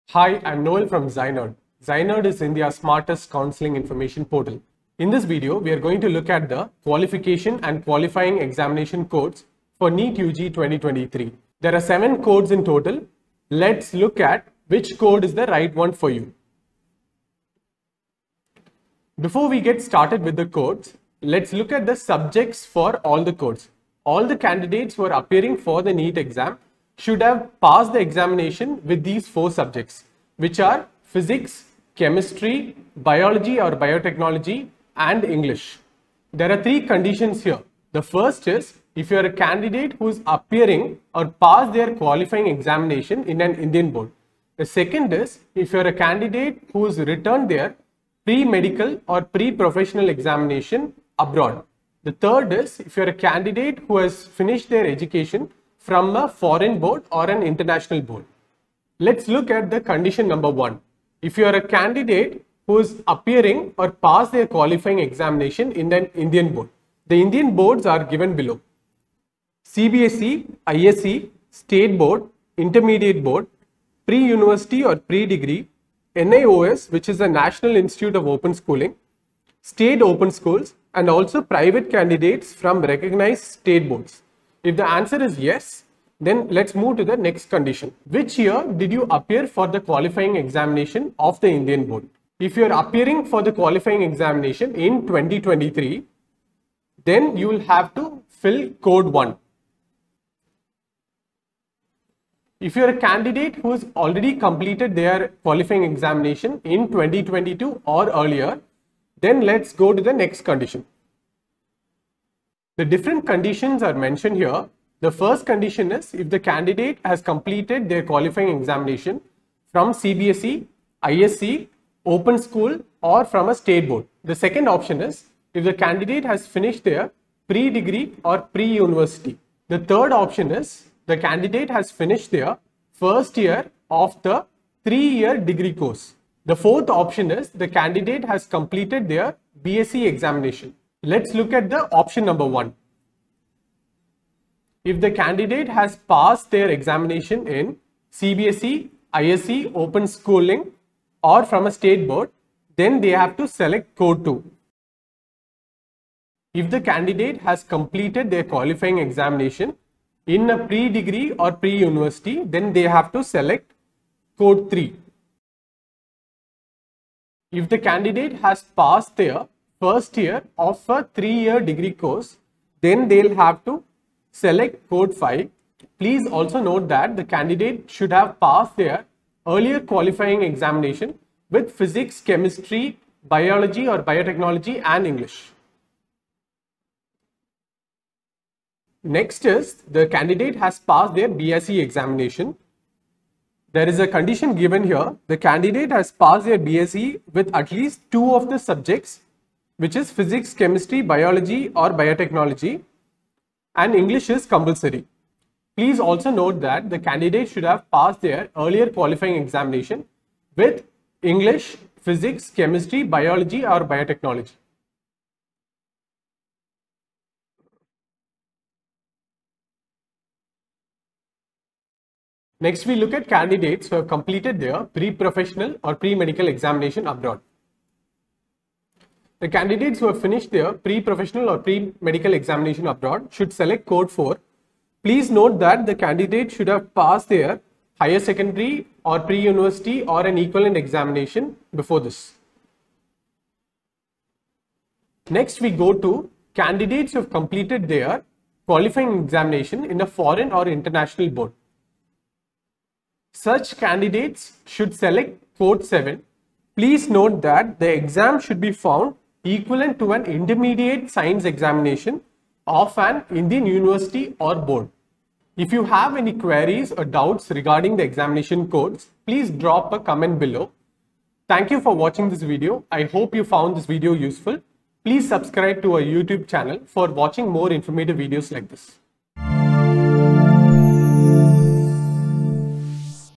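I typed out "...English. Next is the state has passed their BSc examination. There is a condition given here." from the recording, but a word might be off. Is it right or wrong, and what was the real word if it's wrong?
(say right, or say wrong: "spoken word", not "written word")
wrong: "candidate", not "state".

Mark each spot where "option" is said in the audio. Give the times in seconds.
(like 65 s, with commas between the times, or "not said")
124 s, 130 s, 136 s, 141 s.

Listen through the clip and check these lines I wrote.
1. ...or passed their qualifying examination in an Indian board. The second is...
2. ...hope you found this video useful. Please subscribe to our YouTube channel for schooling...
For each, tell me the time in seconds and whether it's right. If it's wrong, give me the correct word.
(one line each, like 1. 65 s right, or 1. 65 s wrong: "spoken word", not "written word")
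1. 41 s right
2. 273 s wrong: "watching", not "schooling".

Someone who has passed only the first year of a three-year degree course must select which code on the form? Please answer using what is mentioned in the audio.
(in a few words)
Code 5.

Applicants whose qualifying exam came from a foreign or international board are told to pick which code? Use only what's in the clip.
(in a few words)
Code 7.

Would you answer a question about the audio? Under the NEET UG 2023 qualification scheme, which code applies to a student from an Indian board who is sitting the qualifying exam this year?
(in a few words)
Code 1.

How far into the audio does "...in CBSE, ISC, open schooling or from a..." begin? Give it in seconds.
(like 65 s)
147 s.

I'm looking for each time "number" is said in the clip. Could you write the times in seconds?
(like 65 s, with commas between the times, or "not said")
60 s, 142 s.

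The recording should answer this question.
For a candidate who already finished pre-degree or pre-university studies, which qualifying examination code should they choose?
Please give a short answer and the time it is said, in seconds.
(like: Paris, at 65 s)
Code 3, at 164 s.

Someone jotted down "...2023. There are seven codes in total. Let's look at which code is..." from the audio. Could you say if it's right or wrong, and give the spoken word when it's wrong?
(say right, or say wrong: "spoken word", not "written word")
right.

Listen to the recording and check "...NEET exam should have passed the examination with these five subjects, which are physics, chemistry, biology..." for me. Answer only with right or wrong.
wrong.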